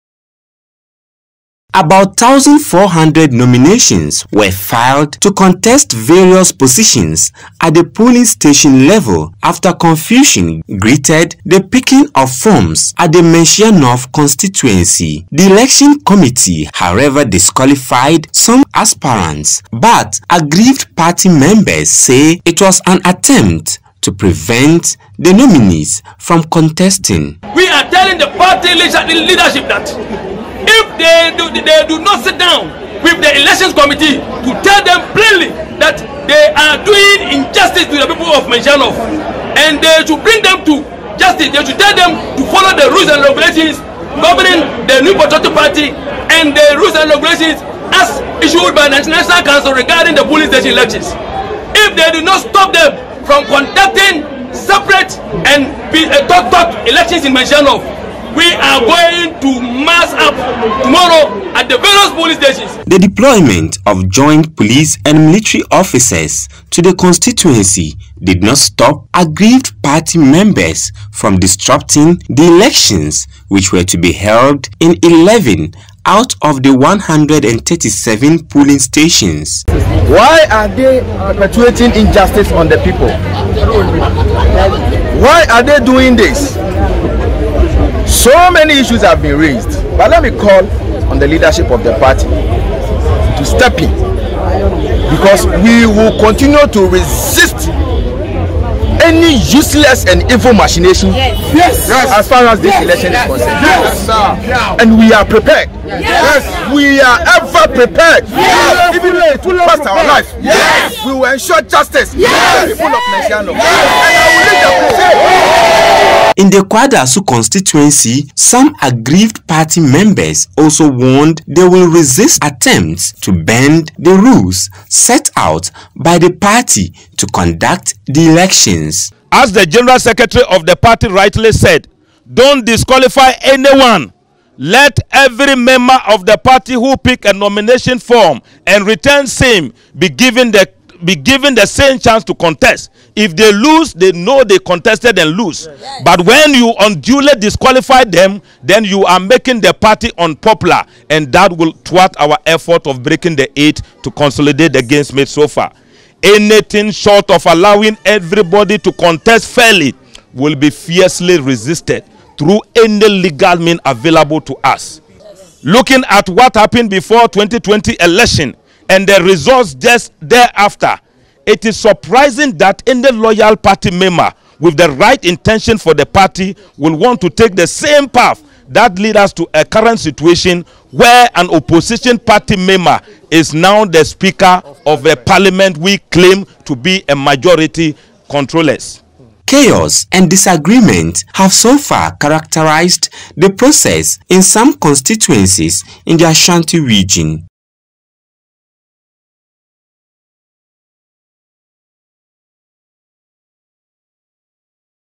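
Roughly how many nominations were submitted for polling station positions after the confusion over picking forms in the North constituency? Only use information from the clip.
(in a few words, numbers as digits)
1,400.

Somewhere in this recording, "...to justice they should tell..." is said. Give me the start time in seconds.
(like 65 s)
40 s.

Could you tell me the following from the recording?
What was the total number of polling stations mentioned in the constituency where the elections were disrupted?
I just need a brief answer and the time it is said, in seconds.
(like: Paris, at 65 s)
137, at 76 s.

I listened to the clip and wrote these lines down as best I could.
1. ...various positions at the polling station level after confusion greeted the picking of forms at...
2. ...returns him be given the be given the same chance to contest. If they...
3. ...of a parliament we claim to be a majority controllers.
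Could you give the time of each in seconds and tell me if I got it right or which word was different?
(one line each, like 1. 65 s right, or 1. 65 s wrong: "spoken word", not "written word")
1. 5 s right
2. 138 s right
3. 184 s right.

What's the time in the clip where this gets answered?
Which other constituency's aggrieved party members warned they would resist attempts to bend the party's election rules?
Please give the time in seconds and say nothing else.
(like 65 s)
116 s.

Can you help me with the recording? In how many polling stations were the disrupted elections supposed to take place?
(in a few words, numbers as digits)
11.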